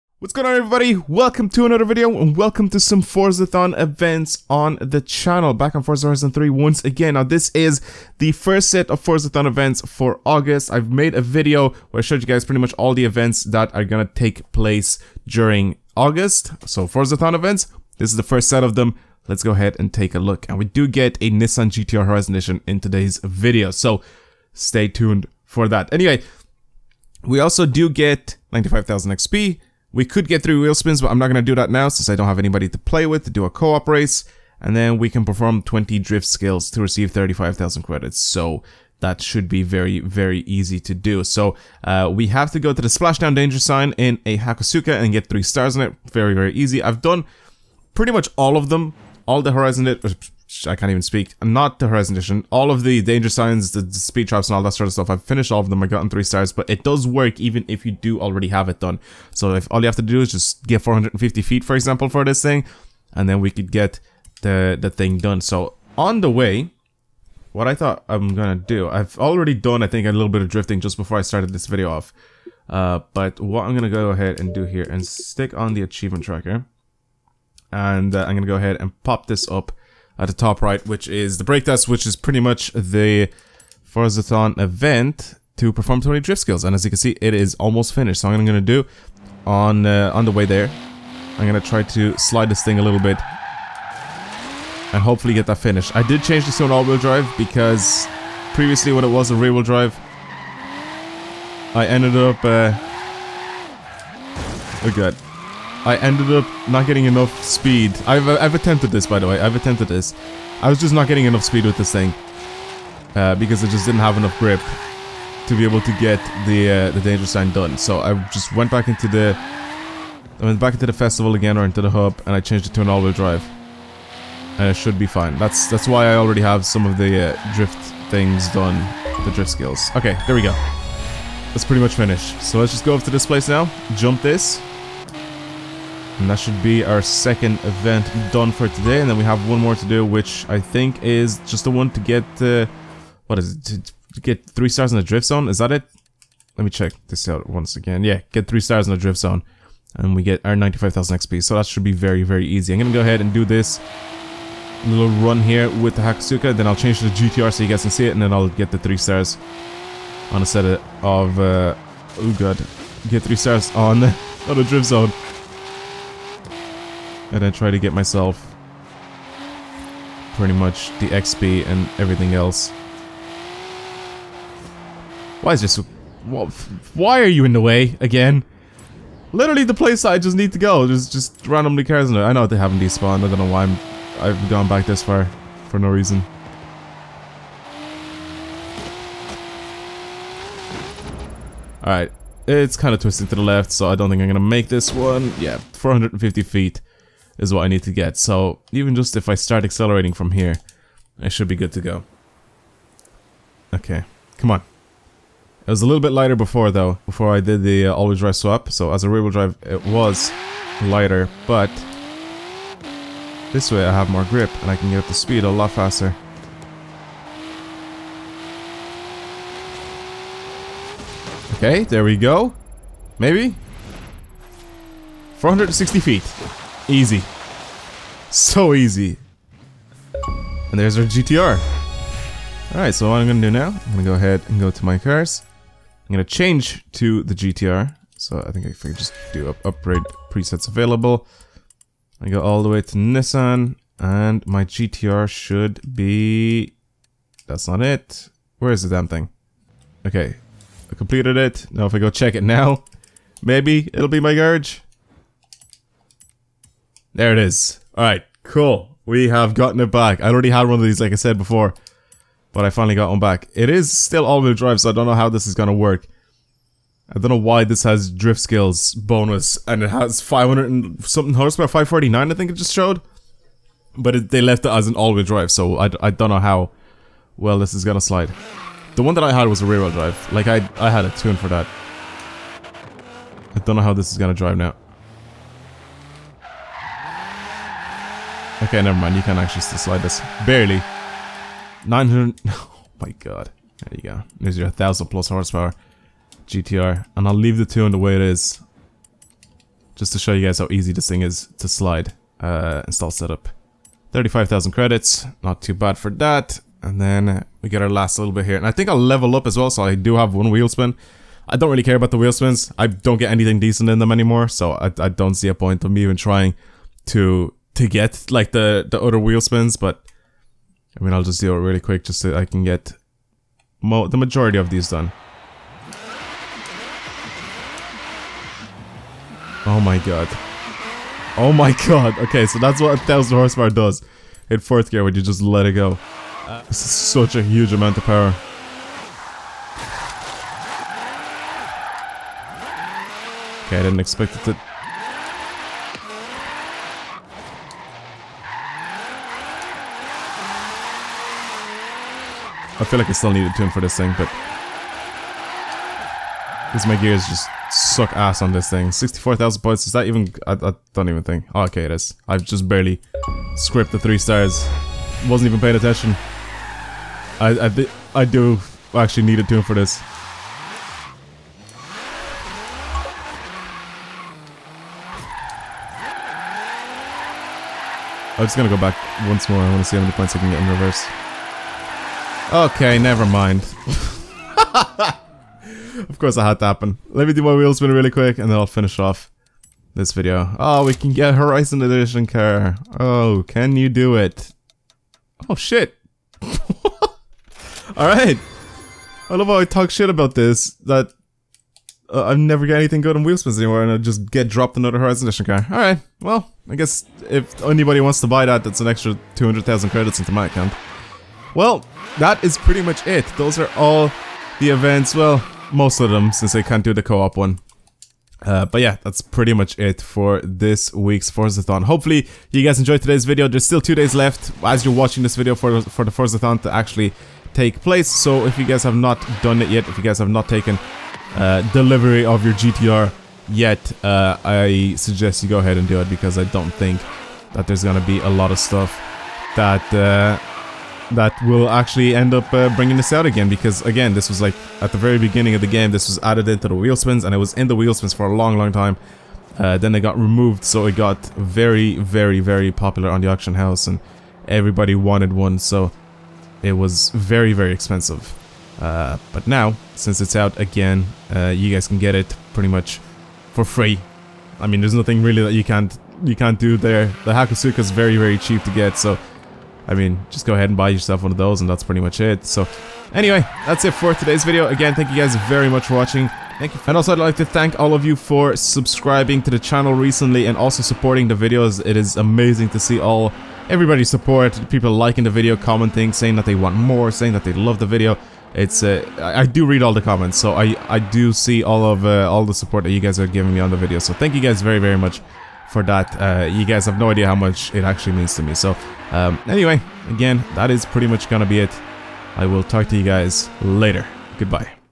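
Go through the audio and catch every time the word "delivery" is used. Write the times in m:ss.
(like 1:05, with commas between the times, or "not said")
7:11.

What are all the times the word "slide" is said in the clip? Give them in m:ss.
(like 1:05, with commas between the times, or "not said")
1:32, 4:38, 4:49, 5:01.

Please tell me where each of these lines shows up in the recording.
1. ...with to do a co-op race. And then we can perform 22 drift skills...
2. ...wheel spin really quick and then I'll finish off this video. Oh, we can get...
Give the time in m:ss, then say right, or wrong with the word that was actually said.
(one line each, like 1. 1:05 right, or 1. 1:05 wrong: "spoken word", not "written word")
1. 0:33 wrong: "20", not "22"
2. 6:27 right.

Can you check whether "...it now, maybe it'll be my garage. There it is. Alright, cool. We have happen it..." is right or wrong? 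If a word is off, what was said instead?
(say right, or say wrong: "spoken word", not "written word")
wrong: "gotten", not "happen".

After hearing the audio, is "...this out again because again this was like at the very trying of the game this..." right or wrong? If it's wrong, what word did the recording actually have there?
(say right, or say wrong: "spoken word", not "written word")
wrong: "beginning", not "trying".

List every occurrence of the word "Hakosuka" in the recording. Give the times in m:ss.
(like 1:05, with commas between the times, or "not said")
0:44, 2:36, 7:47.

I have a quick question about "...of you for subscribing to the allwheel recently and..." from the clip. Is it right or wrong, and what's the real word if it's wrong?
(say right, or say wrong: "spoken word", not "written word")
wrong: "channel", not "allwheel".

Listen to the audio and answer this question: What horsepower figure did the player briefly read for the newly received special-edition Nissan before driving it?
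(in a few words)
549.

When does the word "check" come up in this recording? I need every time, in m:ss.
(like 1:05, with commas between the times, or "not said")
2:26, 4:12.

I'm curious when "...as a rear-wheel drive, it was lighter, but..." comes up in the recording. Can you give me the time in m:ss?
3:28.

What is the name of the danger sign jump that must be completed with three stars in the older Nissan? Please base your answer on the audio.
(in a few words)
Splashdown.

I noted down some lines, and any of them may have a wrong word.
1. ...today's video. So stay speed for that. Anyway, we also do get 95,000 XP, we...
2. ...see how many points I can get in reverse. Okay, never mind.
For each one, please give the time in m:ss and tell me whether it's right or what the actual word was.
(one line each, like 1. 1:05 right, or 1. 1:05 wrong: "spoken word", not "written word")
1. 0:22 wrong: "tuned", not "speed"
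2. 6:19 right.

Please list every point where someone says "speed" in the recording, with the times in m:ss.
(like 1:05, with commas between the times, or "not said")
0:53, 1:47, 1:51, 3:35.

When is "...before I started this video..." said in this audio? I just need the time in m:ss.
1:10.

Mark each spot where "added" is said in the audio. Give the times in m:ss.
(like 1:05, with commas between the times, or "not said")
7:26.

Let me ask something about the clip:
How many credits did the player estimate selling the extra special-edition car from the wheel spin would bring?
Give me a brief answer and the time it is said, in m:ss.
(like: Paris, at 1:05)
200,000, at 6:49.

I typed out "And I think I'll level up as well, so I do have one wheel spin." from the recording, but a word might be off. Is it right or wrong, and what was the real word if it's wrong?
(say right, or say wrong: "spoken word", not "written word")
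right.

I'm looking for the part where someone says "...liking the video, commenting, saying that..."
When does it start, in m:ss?
8:04.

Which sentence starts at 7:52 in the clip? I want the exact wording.
So anyway, that's it for today's video.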